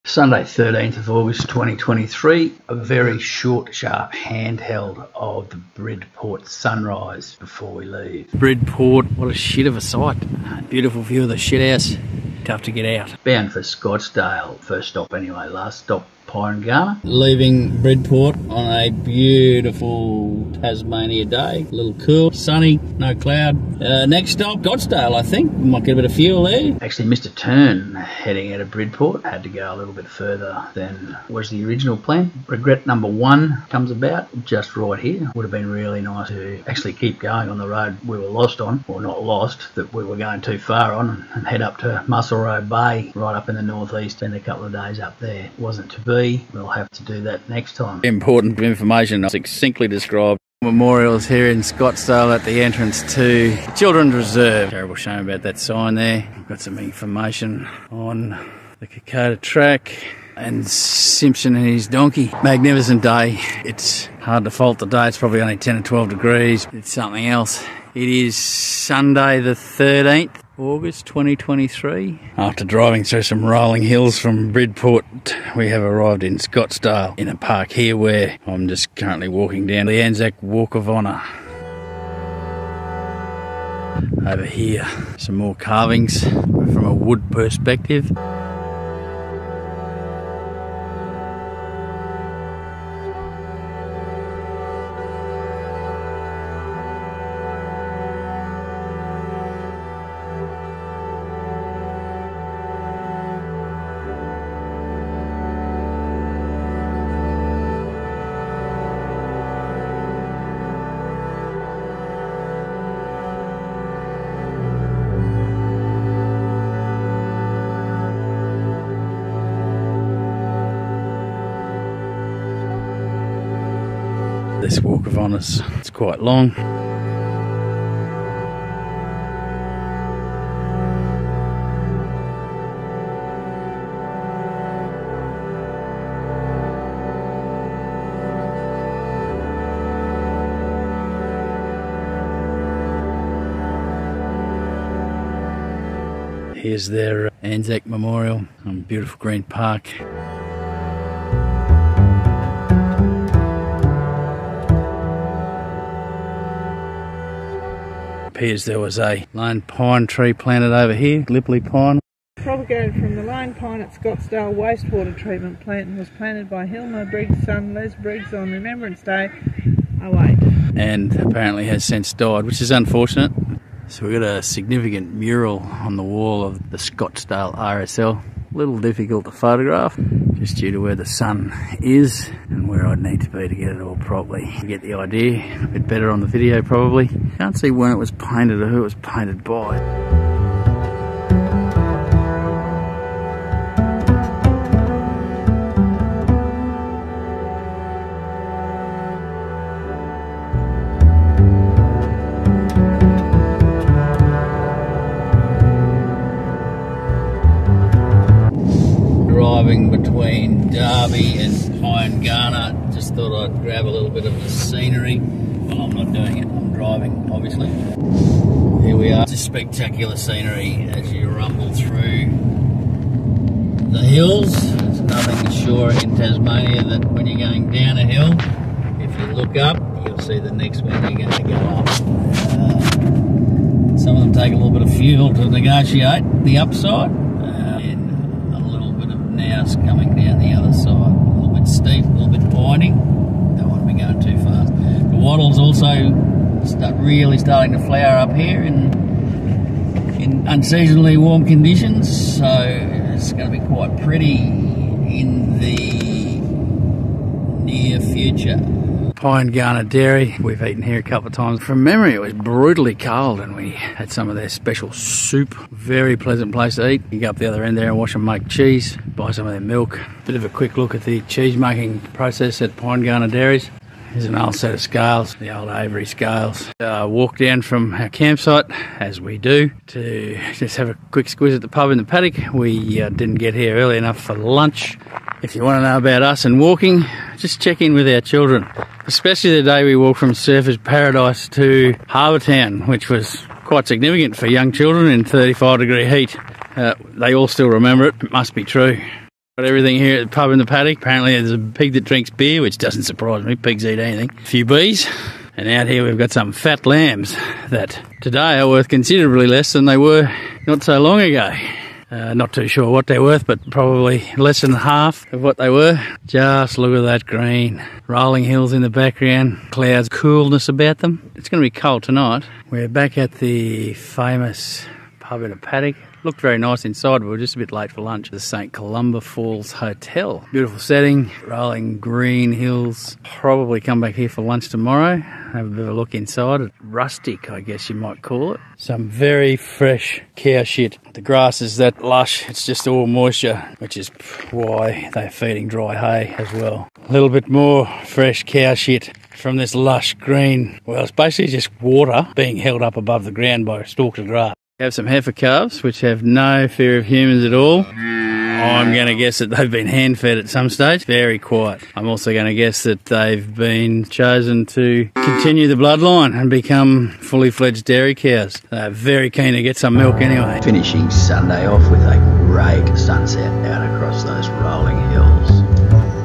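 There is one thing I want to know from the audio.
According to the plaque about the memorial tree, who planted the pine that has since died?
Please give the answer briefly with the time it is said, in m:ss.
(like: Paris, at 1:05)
Les Briggs, at 2:47.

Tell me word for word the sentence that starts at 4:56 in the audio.
Uh, they all still remember it.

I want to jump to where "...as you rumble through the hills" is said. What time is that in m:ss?
3:40.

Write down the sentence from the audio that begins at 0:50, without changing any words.
Memorials here in Scottsdale at the entrance to Children's Reserve.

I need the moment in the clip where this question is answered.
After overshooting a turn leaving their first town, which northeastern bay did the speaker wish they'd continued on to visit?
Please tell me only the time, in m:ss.
0:42.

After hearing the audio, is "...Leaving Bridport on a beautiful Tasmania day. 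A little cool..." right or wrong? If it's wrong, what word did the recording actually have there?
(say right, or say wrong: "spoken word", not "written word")
right.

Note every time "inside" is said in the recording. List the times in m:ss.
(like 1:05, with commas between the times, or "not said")
5:26, 5:36.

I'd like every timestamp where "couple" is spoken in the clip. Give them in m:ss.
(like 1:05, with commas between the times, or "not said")
0:44, 4:21.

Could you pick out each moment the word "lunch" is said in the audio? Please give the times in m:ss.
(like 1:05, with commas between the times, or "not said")
4:44, 5:28, 5:34.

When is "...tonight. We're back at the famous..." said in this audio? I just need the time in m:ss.
5:22.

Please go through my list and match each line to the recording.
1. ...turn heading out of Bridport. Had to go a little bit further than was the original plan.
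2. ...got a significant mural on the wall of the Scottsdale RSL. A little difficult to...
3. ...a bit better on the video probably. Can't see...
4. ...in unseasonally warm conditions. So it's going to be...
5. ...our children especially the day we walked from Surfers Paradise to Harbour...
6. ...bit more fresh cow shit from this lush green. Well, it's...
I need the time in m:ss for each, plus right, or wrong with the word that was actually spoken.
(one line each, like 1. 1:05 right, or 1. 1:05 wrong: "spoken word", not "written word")
1. 0:27 right
2. 2:54 right
3. 3:05 right
4. 4:10 right
5. 4:48 right
6. 5:47 right.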